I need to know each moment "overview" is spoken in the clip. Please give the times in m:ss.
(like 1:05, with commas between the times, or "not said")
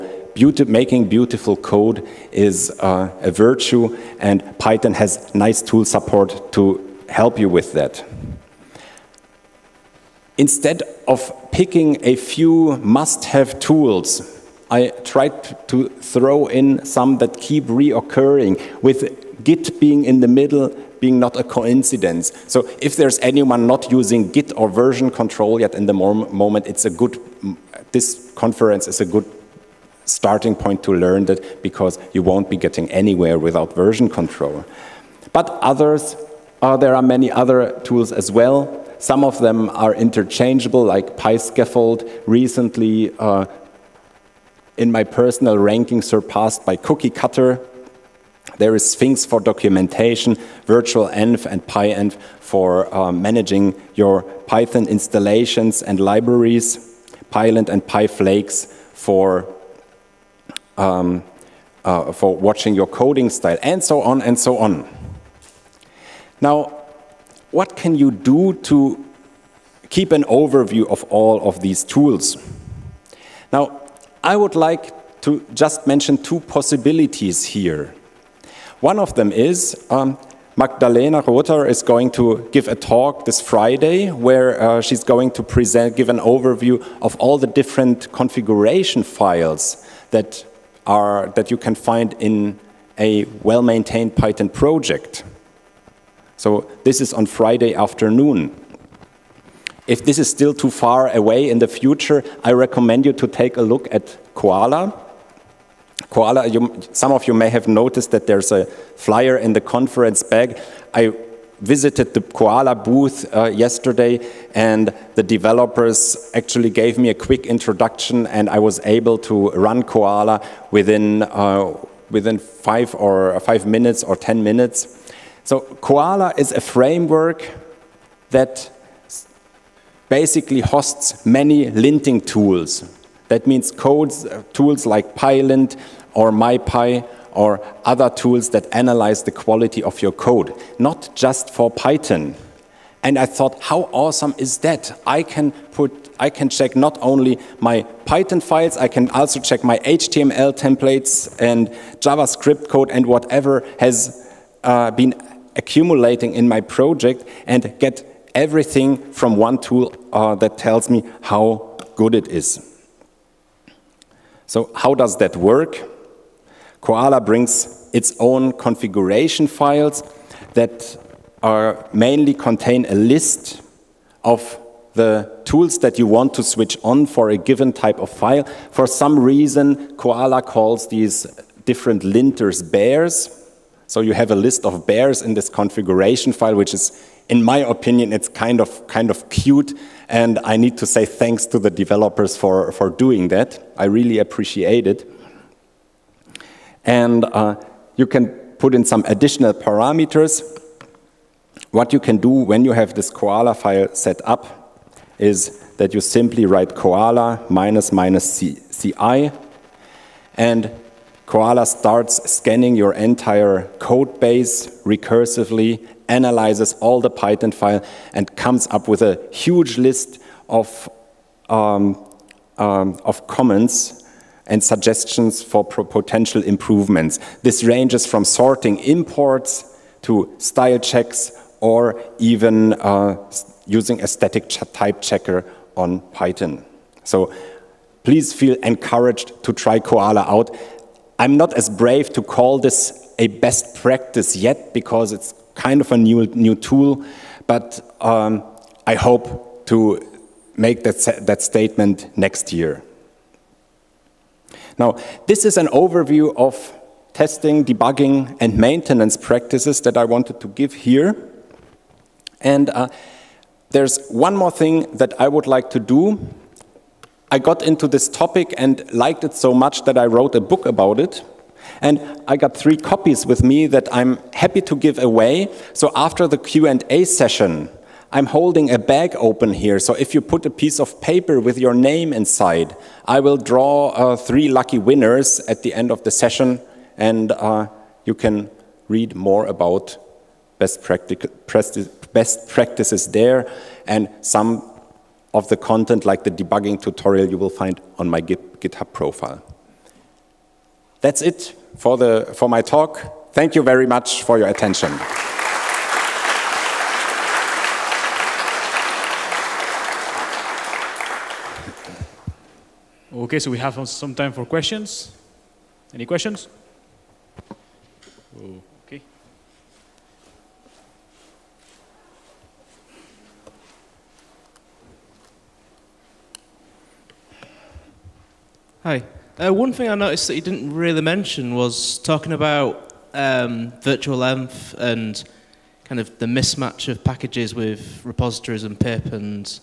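1:10, 1:26, 4:15.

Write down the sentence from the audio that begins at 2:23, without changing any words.
And I thought, how awesome is that?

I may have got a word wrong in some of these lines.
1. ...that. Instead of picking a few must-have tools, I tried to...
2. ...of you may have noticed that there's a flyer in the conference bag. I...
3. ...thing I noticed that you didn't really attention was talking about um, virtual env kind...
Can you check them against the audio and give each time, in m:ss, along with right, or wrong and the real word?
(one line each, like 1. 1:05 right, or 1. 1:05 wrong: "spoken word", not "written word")
1. 0:07 right
2. 1:47 right
3. 5:29 wrong: "mention", not "attention".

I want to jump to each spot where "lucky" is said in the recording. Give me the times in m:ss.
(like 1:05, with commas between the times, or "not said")
4:44.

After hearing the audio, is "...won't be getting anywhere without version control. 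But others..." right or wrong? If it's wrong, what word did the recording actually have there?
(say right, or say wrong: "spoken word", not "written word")
right.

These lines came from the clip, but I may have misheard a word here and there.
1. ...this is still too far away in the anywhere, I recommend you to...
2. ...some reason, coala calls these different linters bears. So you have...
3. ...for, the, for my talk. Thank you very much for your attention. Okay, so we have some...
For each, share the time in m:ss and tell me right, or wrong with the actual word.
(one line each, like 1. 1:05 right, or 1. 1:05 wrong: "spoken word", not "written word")
1. 1:40 wrong: "future", not "anywhere"
2. 2:58 right
3. 5:01 right.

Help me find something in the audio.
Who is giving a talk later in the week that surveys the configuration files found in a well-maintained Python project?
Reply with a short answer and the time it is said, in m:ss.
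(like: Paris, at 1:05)
Magdalena Rother, at 1:20.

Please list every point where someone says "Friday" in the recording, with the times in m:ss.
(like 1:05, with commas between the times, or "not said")
1:23, 1:37.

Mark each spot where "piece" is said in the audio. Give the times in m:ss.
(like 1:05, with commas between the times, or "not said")
4:40.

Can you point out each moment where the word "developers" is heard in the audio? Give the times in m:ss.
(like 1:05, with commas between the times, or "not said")
1:55, 3:11.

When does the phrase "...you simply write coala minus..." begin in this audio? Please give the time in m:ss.
3:25.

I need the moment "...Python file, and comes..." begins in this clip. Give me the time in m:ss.
3:37.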